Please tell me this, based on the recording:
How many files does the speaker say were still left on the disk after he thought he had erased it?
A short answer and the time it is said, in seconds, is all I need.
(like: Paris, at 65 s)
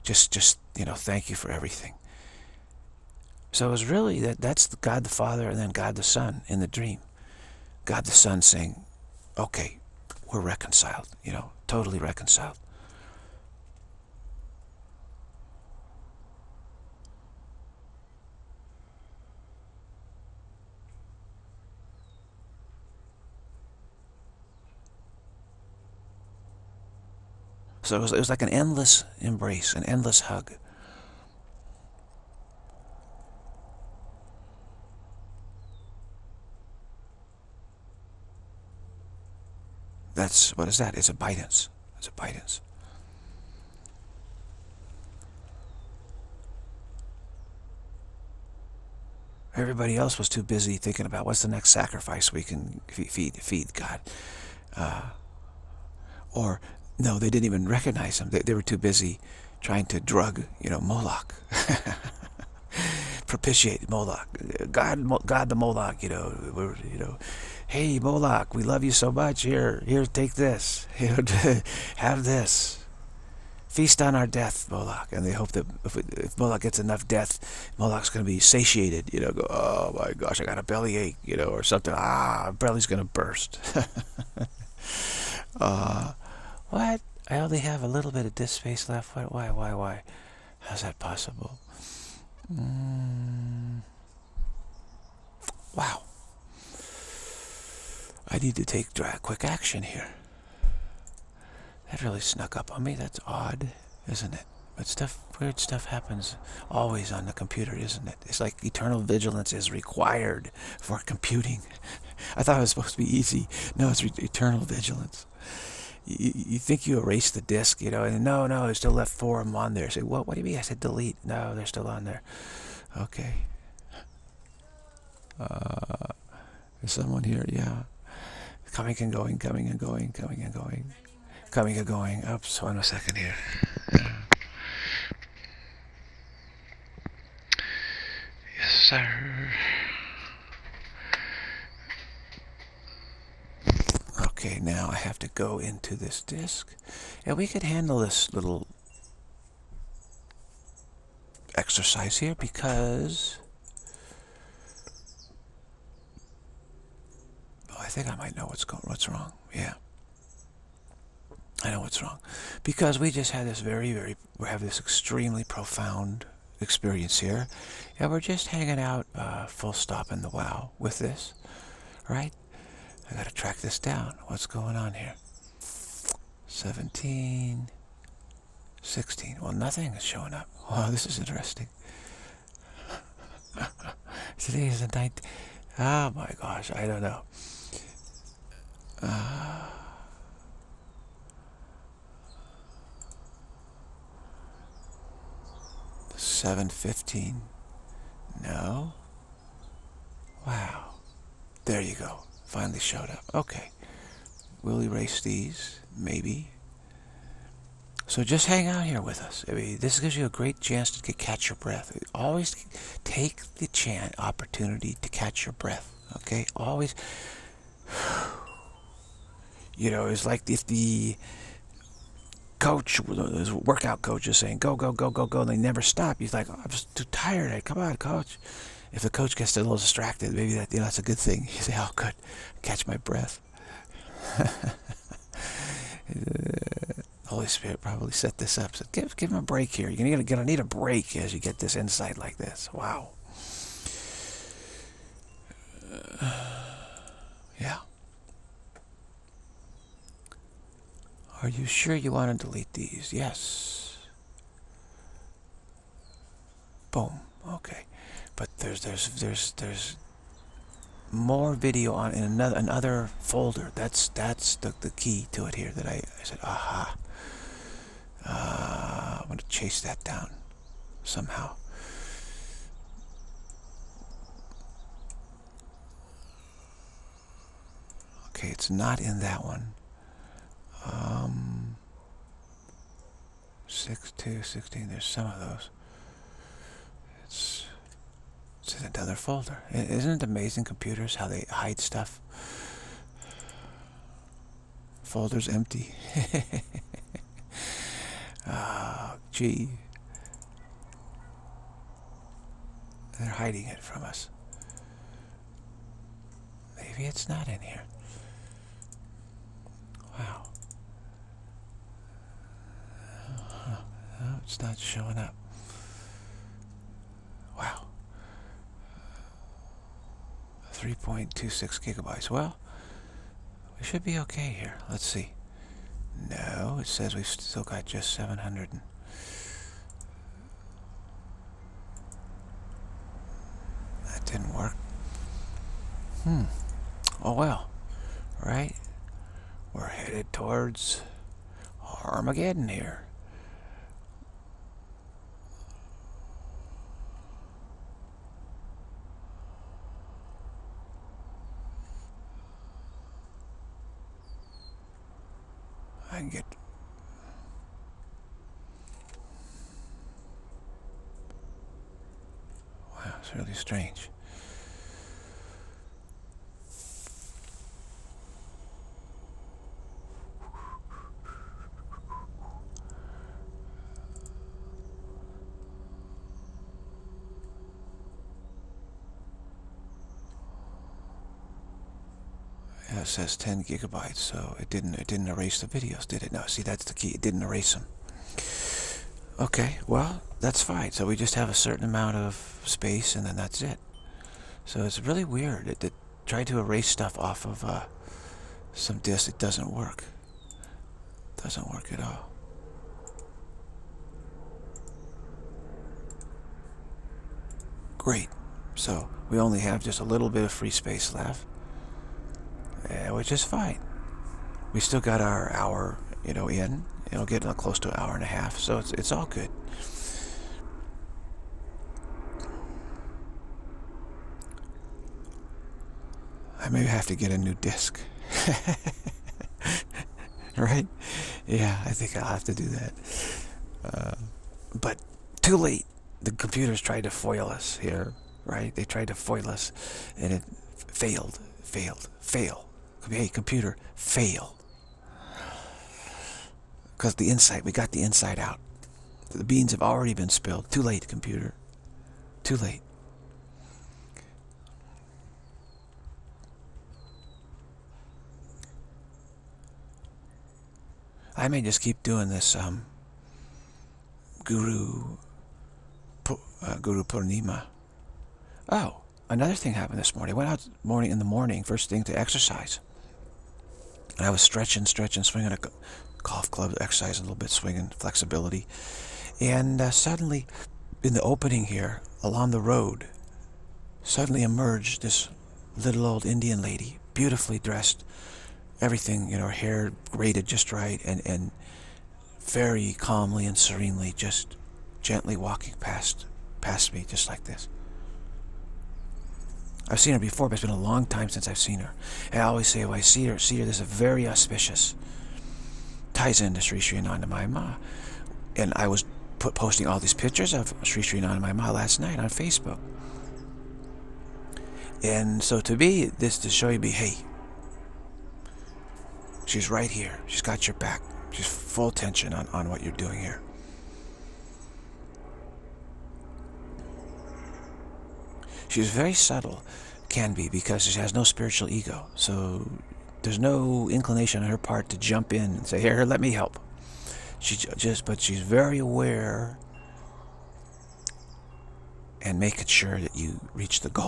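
4, at 119 s.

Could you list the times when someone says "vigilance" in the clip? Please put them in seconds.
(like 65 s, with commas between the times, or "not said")
108 s, 114 s.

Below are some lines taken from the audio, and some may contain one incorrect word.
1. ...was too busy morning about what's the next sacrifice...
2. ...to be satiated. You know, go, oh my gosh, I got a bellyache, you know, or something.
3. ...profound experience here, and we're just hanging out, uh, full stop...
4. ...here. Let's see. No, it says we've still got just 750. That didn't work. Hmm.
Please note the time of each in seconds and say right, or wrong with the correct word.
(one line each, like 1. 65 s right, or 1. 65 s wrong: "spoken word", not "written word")
1. 50 s wrong: "thinking", not "morning"
2. 78 s right
3. 165 s right
4. 324 s wrong: "700", not "750".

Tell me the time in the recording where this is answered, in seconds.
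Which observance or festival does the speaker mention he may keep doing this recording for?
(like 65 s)
466 s.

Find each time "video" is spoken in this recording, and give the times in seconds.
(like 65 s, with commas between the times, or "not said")
261 s, 385 s.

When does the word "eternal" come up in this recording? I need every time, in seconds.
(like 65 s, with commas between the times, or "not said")
108 s, 114 s.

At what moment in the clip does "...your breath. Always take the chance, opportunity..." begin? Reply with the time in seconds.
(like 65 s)
211 s.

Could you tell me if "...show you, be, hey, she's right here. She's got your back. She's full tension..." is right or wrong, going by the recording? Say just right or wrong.
right.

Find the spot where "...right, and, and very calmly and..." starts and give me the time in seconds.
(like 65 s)
490 s.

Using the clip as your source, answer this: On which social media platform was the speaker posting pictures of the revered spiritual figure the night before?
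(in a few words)
Facebook.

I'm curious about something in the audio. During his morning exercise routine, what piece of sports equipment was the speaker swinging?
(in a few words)
Golf club.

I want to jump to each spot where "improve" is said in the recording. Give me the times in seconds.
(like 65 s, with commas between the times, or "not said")
not said.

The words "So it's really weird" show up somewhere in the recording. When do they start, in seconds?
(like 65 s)
394 s.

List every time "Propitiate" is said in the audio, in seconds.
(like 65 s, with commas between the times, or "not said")
63 s.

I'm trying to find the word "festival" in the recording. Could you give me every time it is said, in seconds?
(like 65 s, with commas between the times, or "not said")
not said.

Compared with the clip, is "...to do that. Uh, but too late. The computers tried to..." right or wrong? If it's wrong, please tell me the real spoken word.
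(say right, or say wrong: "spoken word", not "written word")
right.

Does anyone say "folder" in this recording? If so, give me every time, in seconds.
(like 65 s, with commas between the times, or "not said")
263 s, 289 s, 295 s.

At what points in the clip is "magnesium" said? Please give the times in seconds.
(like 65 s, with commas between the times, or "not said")
not said.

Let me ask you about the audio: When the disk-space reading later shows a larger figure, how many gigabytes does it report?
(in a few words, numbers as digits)
10 gigabytes.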